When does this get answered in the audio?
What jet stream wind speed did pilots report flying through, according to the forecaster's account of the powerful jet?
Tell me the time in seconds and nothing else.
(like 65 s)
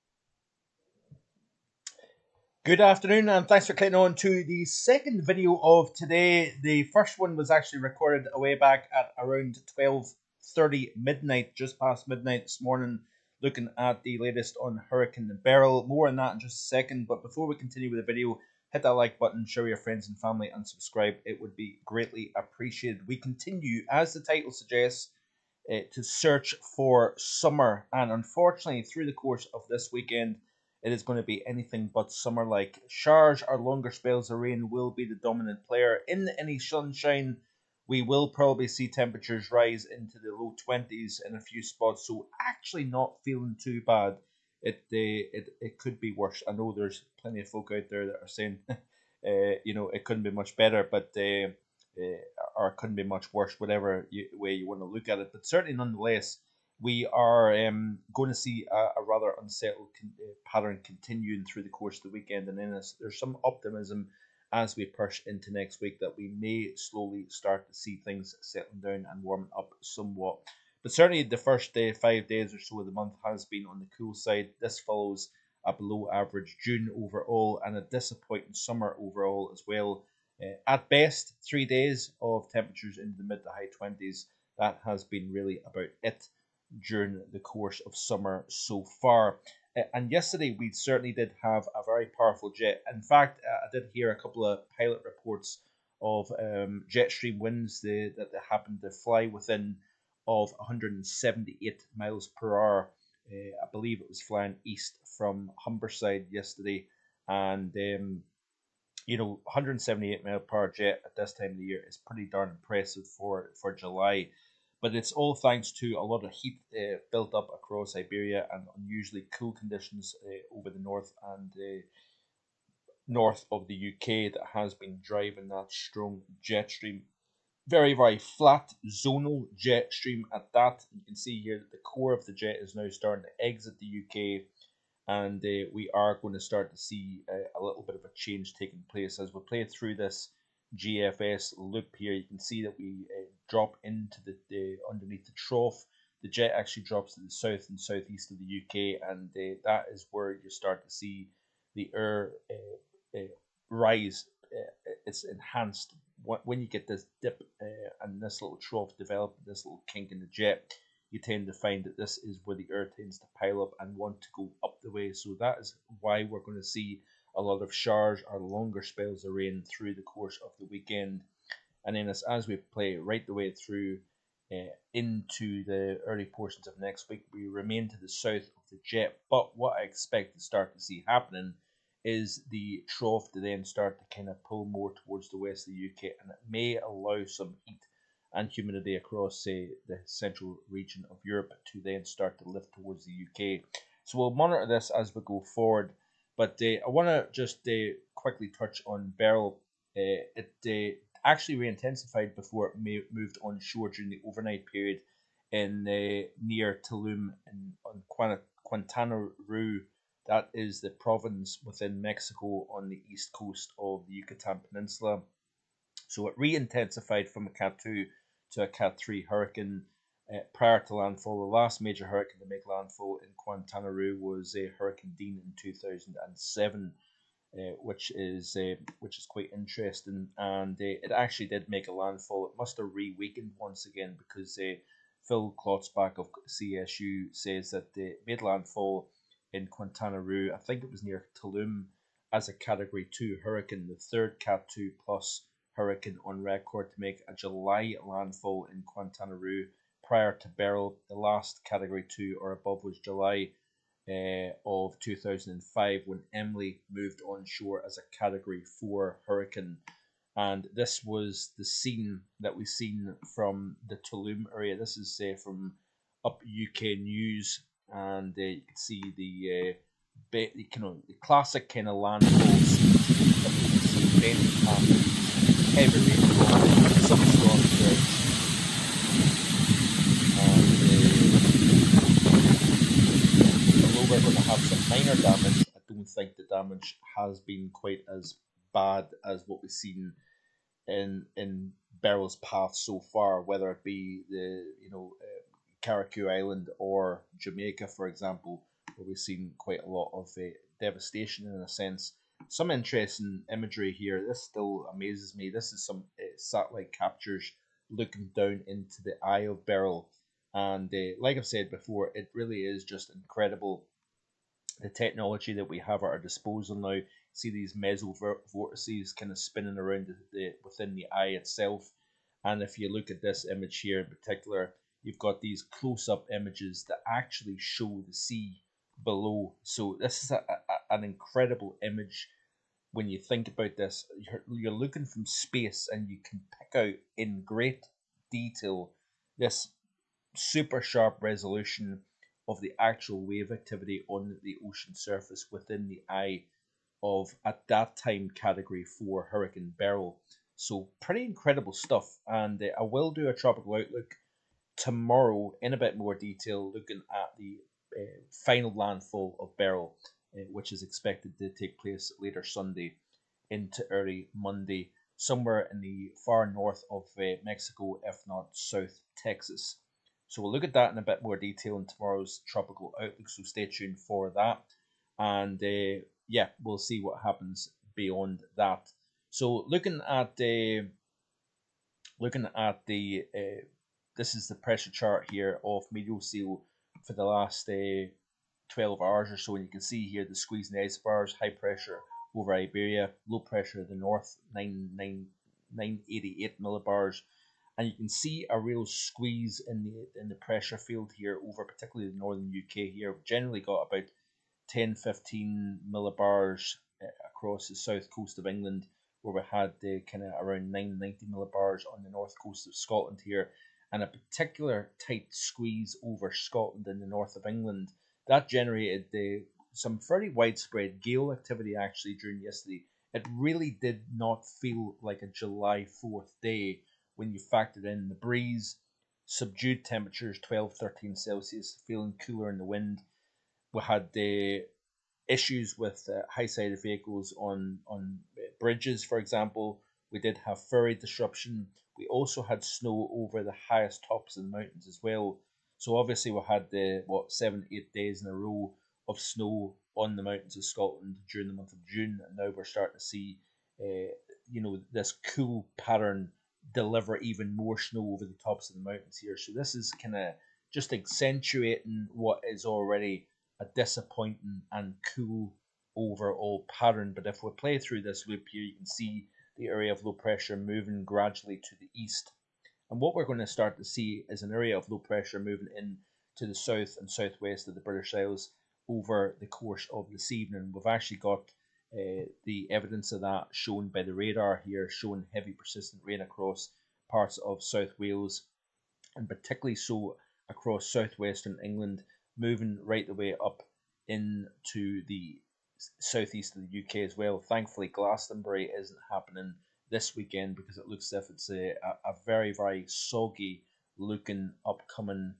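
100 s.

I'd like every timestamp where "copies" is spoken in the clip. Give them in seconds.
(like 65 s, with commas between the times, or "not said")
not said.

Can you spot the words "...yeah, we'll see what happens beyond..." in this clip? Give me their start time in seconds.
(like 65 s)
376 s.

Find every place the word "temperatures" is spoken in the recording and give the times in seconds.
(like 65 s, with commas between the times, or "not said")
38 s, 82 s, 429 s.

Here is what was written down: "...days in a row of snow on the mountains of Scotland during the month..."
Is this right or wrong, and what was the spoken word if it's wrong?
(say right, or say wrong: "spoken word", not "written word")
right.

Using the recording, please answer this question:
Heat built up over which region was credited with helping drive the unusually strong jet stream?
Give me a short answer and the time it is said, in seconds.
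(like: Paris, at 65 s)
Siberia, at 117 s.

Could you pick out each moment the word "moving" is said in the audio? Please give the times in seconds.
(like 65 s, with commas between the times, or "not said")
470 s, 475 s, 492 s.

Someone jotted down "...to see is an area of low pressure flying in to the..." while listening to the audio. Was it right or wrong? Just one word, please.
wrong.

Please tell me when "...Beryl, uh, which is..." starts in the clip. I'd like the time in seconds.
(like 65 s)
359 s.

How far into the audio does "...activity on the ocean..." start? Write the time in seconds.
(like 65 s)
343 s.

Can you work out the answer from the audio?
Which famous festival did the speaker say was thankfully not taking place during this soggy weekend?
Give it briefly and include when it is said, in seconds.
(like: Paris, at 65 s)
Glastonbury, at 497 s.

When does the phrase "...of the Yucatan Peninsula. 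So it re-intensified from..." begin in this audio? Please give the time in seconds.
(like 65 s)
213 s.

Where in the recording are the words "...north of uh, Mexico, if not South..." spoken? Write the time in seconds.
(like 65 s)
366 s.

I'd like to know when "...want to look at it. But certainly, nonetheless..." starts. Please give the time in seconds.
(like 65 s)
54 s.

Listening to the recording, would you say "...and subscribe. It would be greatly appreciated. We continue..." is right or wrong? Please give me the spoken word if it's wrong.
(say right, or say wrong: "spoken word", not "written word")
right.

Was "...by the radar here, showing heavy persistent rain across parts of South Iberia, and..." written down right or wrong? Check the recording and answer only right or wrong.
wrong.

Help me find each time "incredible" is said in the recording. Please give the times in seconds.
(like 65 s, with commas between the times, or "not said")
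313 s, 331 s, 351 s.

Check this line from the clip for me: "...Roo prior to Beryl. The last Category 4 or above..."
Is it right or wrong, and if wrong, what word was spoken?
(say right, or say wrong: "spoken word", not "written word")
wrong: "2", not "4".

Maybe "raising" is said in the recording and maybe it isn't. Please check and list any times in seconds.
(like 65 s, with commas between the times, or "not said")
not said.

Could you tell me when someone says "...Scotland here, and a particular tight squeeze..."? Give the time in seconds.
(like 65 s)
412 s.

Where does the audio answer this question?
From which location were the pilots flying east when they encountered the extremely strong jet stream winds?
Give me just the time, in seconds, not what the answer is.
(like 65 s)
105 s.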